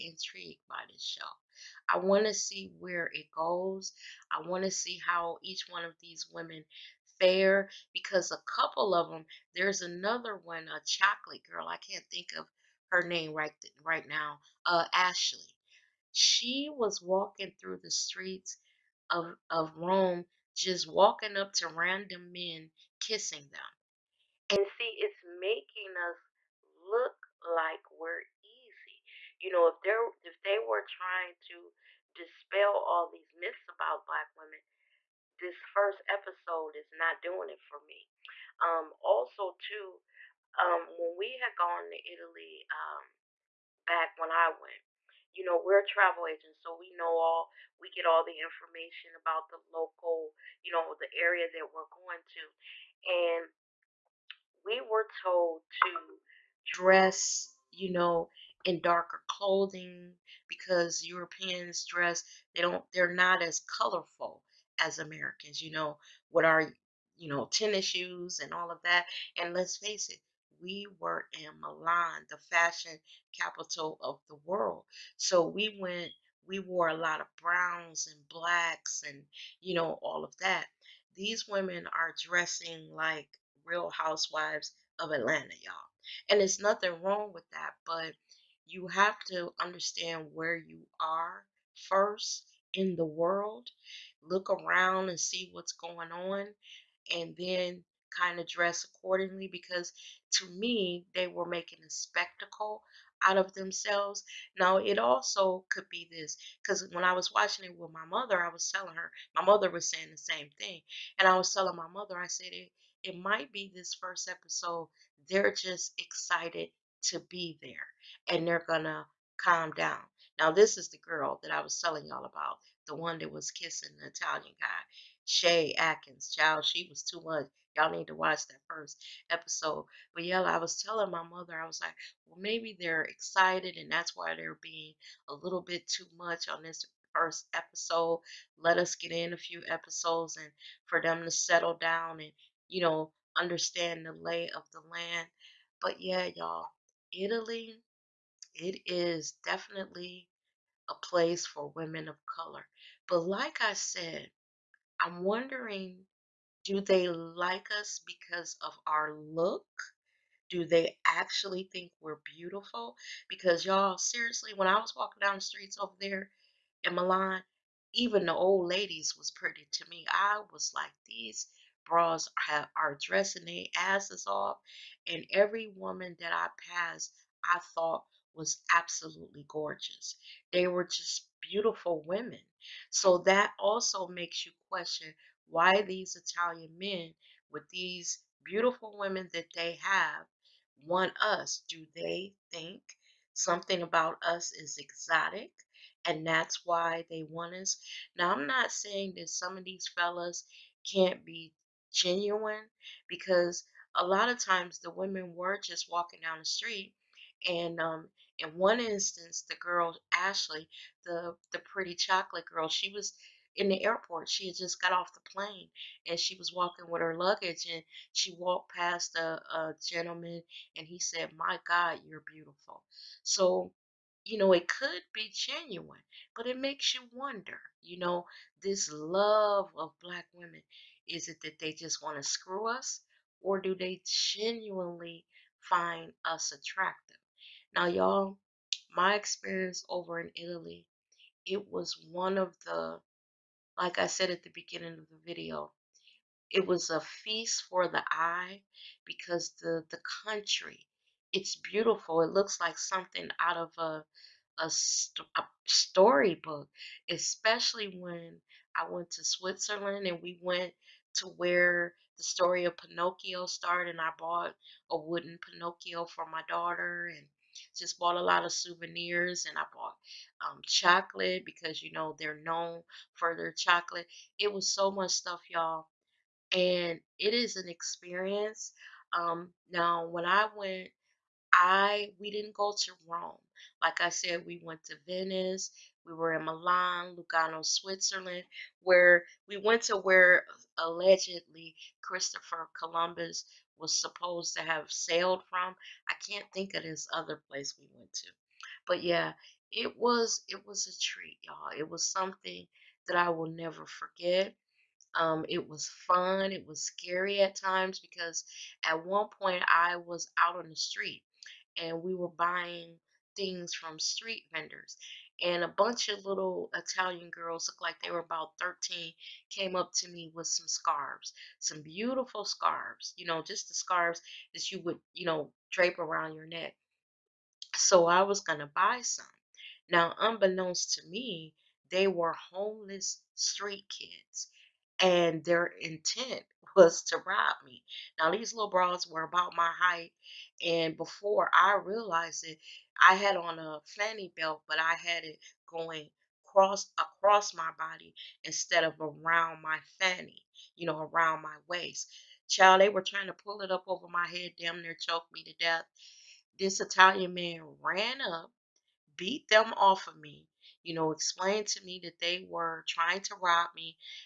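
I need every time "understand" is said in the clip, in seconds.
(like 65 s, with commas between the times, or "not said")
89 s, 143 s.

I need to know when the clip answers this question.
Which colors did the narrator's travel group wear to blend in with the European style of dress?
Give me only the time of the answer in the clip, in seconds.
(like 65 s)
77 s.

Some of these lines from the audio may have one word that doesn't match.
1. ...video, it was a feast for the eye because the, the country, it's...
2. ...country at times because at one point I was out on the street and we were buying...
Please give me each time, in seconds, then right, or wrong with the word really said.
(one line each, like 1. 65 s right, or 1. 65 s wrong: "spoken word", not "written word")
1. 245 s right
2. 306 s wrong: "scary", not "country".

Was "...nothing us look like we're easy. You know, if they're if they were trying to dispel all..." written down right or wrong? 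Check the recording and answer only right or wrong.
wrong.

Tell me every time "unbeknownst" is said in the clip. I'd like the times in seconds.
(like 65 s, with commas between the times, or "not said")
330 s.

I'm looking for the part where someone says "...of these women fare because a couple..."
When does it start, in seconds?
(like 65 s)
5 s.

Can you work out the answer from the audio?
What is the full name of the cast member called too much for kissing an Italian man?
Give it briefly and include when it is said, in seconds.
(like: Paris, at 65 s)
Shay Atkins, at 125 s.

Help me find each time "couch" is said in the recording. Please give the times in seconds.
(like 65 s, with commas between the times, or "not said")
not said.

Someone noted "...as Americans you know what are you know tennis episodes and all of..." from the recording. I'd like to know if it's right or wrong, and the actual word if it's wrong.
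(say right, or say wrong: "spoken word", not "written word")
wrong: "shoes", not "episodes".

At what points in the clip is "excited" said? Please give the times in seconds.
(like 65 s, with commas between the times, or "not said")
115 s, 133 s.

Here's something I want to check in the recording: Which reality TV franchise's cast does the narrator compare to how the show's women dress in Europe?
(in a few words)
Real Housewives of Atlanta.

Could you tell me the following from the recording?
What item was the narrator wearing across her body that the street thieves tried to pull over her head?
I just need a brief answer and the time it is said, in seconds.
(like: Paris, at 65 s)
fanny belt, at 343 s.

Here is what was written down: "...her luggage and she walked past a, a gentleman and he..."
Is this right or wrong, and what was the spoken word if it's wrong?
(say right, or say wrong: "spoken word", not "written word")
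right.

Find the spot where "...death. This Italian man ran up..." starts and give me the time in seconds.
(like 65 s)
355 s.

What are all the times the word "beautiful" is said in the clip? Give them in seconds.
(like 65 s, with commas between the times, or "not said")
162 s, 181 s, 188 s, 222 s, 251 s, 321 s.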